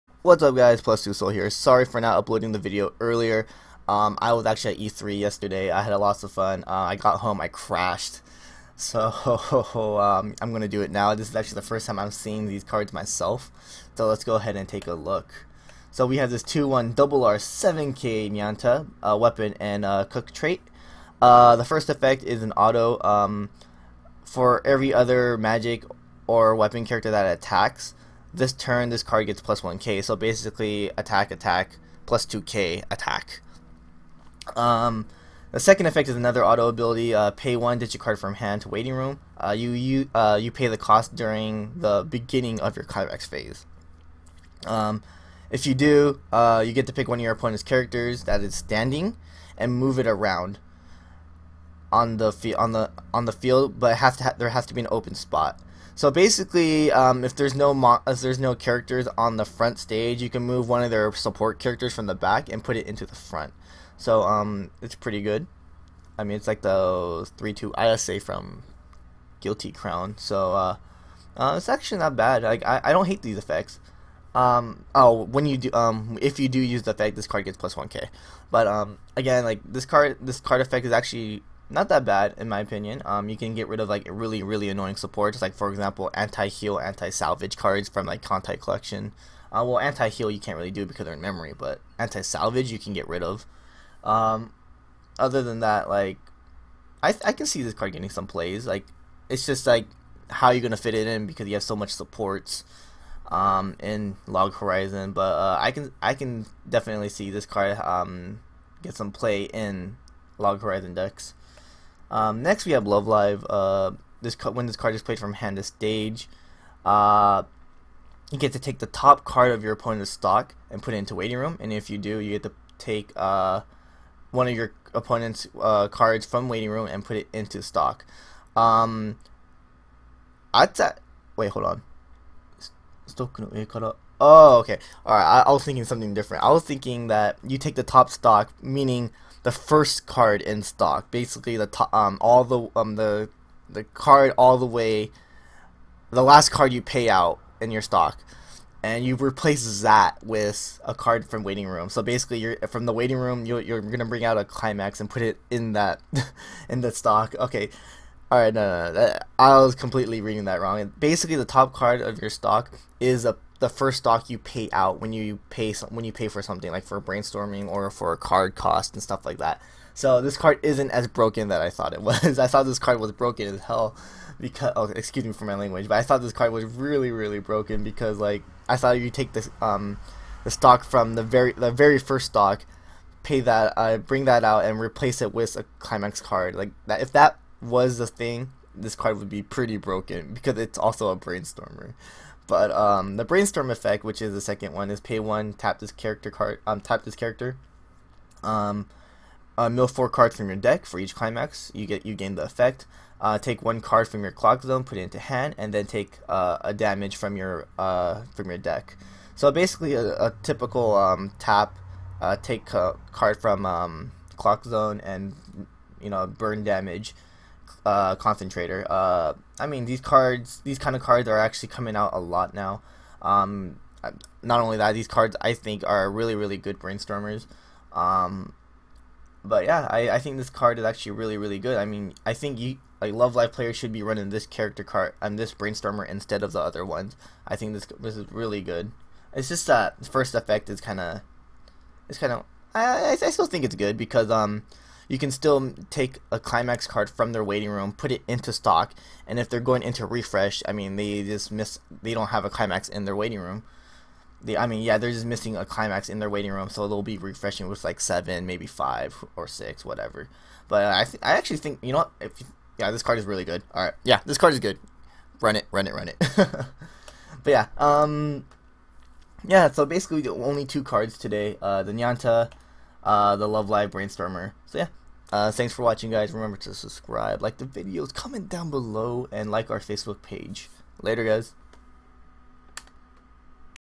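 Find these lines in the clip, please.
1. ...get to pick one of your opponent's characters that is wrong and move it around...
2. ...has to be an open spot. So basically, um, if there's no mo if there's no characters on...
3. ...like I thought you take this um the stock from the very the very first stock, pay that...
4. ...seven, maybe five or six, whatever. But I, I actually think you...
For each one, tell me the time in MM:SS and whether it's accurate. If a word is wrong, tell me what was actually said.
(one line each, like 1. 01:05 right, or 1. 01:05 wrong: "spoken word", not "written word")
1. 00:46 wrong: "standing", not "wrong"
2. 00:54 right
3. 02:58 right
4. 04:17 right.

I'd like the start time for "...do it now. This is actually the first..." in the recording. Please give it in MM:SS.
00:10.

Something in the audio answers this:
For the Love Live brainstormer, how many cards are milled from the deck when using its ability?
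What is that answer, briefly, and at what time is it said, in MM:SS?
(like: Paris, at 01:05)
4, at 03:19.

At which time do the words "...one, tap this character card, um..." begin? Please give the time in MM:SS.
03:15.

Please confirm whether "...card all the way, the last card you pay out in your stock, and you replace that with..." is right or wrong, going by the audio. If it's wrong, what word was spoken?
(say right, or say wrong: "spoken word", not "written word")
right.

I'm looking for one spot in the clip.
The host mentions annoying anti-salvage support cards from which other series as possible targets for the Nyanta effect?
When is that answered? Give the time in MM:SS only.
01:28.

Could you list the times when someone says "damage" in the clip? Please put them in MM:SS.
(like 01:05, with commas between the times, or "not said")
03:26, 03:36.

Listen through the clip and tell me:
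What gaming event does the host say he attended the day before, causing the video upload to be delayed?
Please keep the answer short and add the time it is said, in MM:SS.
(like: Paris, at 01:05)
E3, at 00:04.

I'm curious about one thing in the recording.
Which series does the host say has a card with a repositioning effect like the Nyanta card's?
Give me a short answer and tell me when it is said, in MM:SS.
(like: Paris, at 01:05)
Guilty Crown, at 01:09.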